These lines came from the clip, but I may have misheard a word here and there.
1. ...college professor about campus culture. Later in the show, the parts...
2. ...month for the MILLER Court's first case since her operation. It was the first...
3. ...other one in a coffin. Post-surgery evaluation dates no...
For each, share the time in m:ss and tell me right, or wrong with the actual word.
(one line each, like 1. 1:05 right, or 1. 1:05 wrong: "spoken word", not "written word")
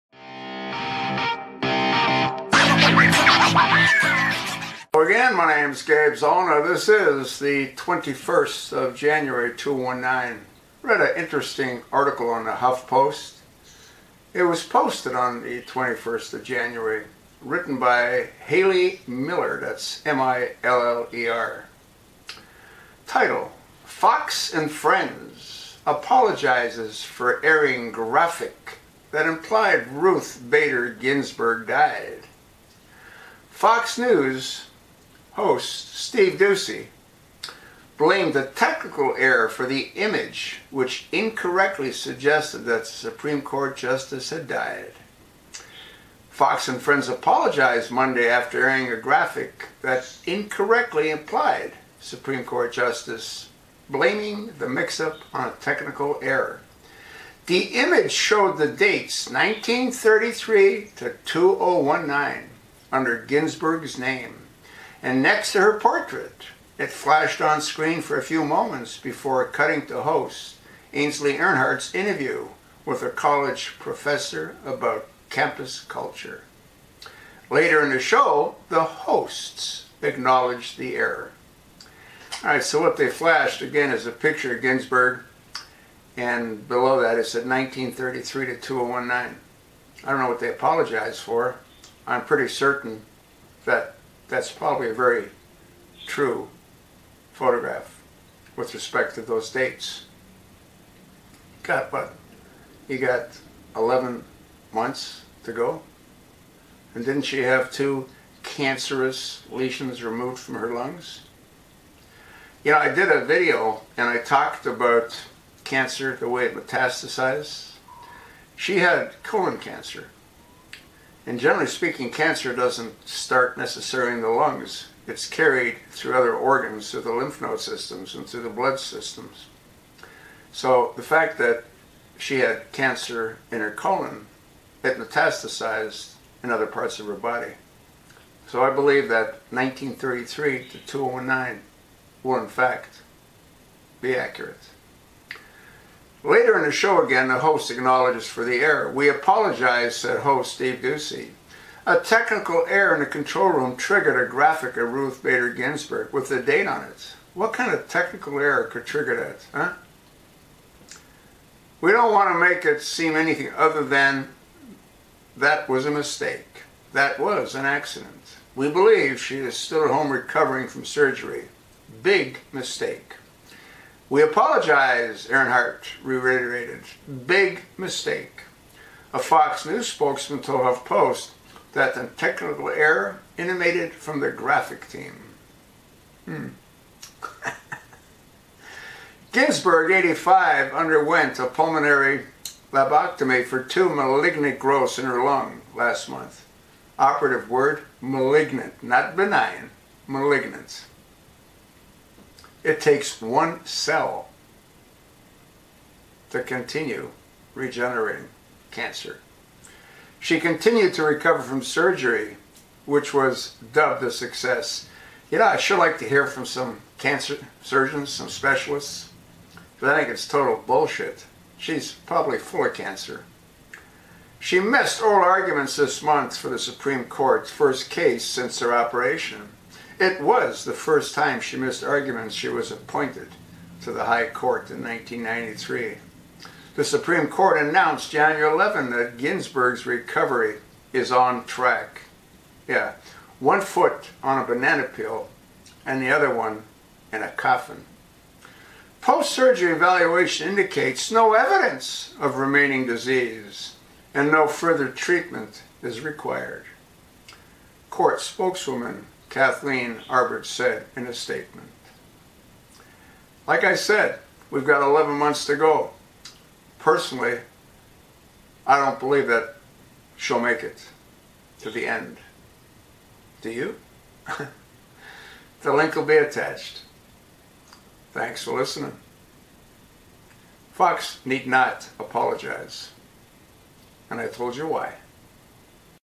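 1. 1:13 wrong: "hosts", not "parts"
2. 3:46 wrong: "Supreme", not "MILLER"
3. 4:06 wrong: "indicates", not "dates".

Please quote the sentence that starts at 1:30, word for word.
I don't know what they apologized for.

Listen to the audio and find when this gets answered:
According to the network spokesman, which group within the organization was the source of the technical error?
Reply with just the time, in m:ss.
3:04.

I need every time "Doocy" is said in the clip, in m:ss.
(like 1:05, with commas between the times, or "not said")
0:36, 2:30.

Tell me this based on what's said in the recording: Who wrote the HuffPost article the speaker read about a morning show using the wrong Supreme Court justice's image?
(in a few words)
Haley Miller.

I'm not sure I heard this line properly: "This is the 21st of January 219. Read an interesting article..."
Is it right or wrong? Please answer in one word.
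right.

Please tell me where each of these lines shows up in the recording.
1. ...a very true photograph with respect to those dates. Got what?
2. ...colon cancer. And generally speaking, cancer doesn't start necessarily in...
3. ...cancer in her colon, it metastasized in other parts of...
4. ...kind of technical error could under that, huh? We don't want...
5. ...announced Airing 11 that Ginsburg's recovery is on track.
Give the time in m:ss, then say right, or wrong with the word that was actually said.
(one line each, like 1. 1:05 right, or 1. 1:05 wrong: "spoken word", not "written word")
1. 1:34 right
2. 1:59 right
3. 2:12 right
4. 2:37 wrong: "trigger", not "under"
5. 3:57 wrong: "January", not "Airing".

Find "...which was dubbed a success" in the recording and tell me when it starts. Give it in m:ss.
3:32.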